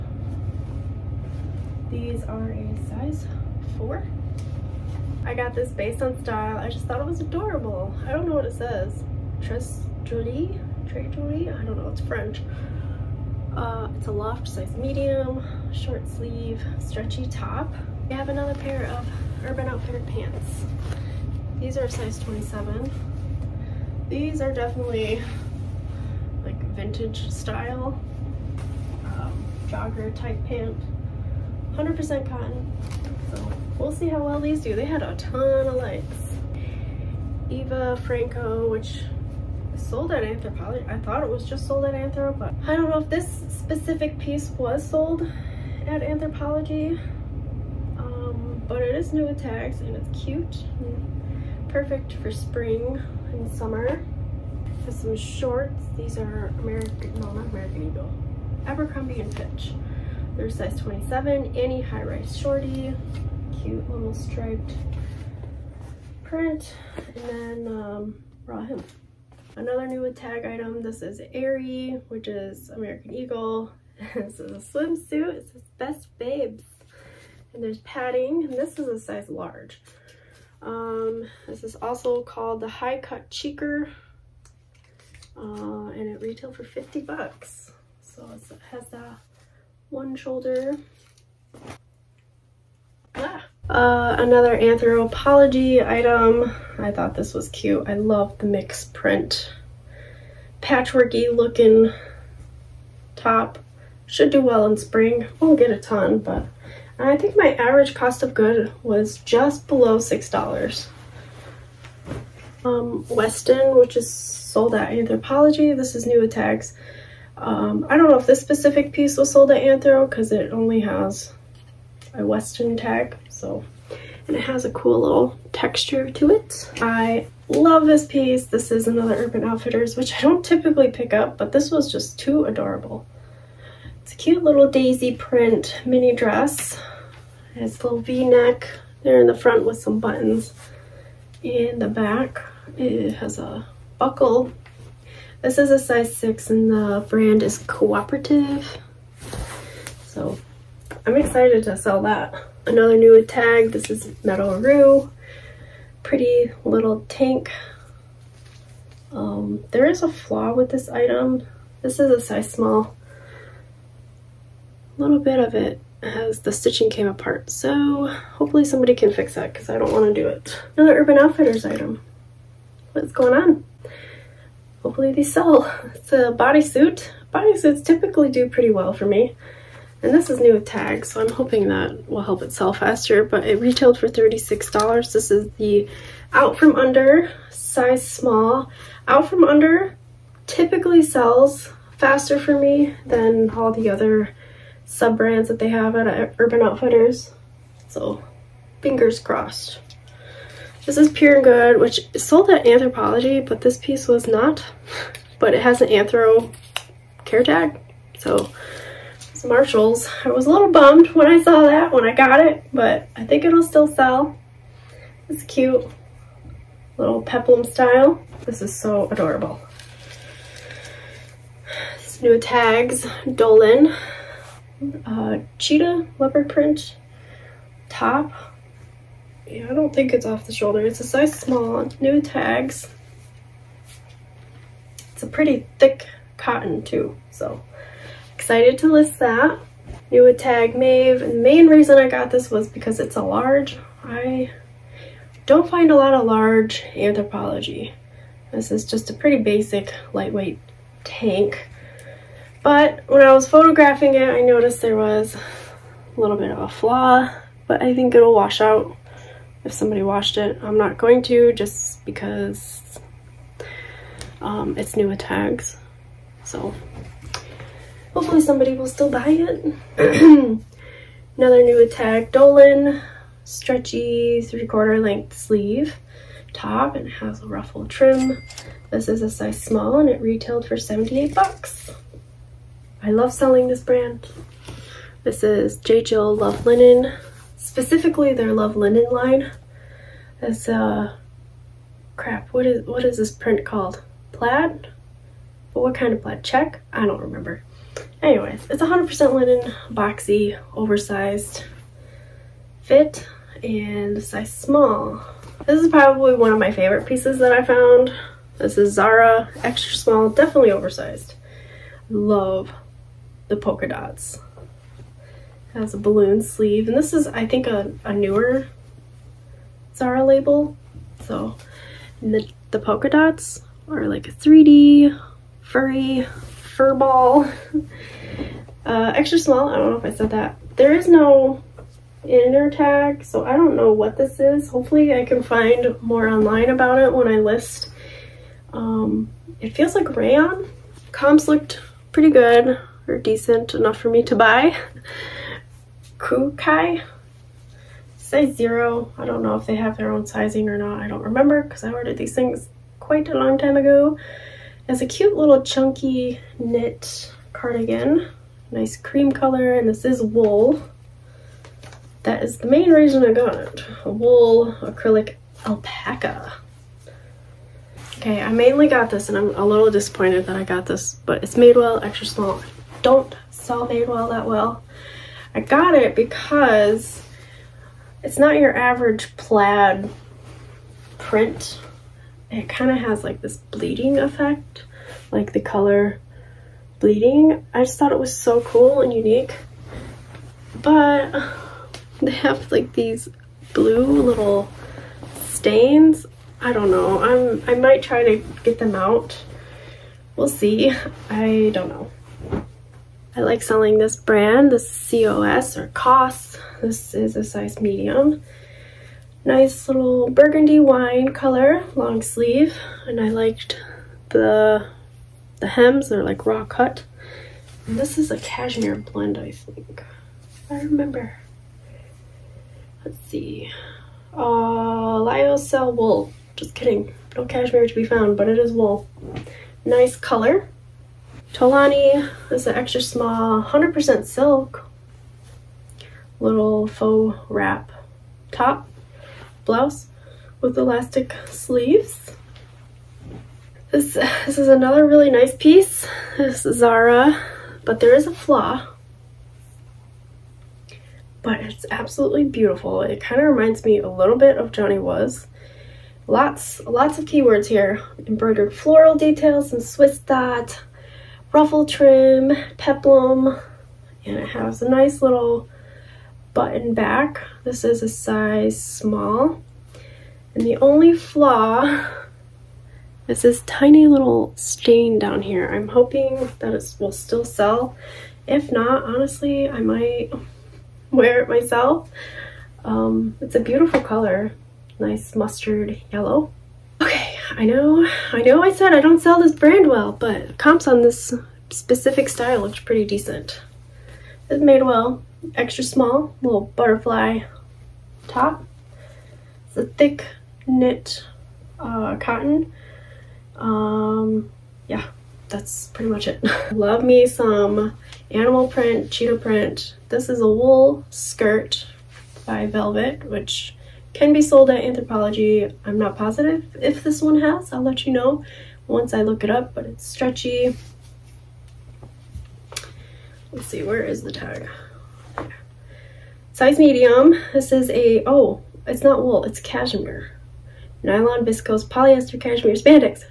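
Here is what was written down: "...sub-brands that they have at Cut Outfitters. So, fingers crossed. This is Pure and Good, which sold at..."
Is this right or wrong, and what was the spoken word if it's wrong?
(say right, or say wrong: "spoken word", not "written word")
wrong: "Urban", not "Cut".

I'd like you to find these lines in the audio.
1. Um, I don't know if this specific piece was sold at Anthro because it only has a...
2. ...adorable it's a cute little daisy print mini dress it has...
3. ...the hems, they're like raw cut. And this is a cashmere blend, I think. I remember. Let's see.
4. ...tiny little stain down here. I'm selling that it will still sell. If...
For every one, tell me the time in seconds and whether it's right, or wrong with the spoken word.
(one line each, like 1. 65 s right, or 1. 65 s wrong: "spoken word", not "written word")
1. 117 s right
2. 132 s right
3. 415 s right
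4. 473 s wrong: "hoping", not "selling".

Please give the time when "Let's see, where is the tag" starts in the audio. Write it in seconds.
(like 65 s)
523 s.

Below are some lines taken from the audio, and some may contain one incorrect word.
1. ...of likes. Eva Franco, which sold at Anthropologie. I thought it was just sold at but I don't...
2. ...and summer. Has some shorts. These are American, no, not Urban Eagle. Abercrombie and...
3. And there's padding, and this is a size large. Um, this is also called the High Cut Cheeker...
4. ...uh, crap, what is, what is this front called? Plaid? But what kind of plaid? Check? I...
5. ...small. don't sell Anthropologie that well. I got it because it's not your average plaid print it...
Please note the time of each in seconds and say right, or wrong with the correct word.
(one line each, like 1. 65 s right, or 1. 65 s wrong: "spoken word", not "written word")
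1. 35 s right
2. 53 s wrong: "American", not "Urban"
3. 77 s right
4. 290 s wrong: "print", not "front"
5. 372 s wrong: "Madewell", not "Anthropologie".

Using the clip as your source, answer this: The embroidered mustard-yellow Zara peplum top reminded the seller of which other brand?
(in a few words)
Johnny Was.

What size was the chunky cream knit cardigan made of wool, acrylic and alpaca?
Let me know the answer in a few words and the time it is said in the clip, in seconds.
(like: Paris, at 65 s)
0, at 348 s.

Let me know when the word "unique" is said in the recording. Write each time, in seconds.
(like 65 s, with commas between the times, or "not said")
389 s.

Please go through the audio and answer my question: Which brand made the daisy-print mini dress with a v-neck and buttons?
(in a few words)
Cooperative.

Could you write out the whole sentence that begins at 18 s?
We have another pair of Urban Outfitter pants.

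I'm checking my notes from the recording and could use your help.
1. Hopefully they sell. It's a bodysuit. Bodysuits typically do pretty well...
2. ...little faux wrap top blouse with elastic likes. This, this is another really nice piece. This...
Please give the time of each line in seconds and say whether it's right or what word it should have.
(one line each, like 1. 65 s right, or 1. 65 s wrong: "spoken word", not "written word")
1. 174 s right
2. 436 s wrong: "sleeves", not "likes".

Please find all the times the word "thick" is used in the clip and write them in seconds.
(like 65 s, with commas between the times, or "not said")
235 s, 499 s.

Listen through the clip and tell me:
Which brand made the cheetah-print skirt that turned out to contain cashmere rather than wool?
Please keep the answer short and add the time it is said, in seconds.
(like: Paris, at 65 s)
Velvet, at 512 s.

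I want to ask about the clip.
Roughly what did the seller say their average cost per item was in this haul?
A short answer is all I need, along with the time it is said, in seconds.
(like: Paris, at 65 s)
just below $6, at 109 s.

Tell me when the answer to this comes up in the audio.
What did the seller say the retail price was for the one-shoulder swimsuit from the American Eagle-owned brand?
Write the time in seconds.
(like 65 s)
86 s.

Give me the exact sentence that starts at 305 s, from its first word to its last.
This is probably one of my favorite pieces that I found.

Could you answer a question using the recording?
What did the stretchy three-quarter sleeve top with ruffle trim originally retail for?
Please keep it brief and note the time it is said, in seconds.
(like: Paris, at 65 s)
$78, at 280 s.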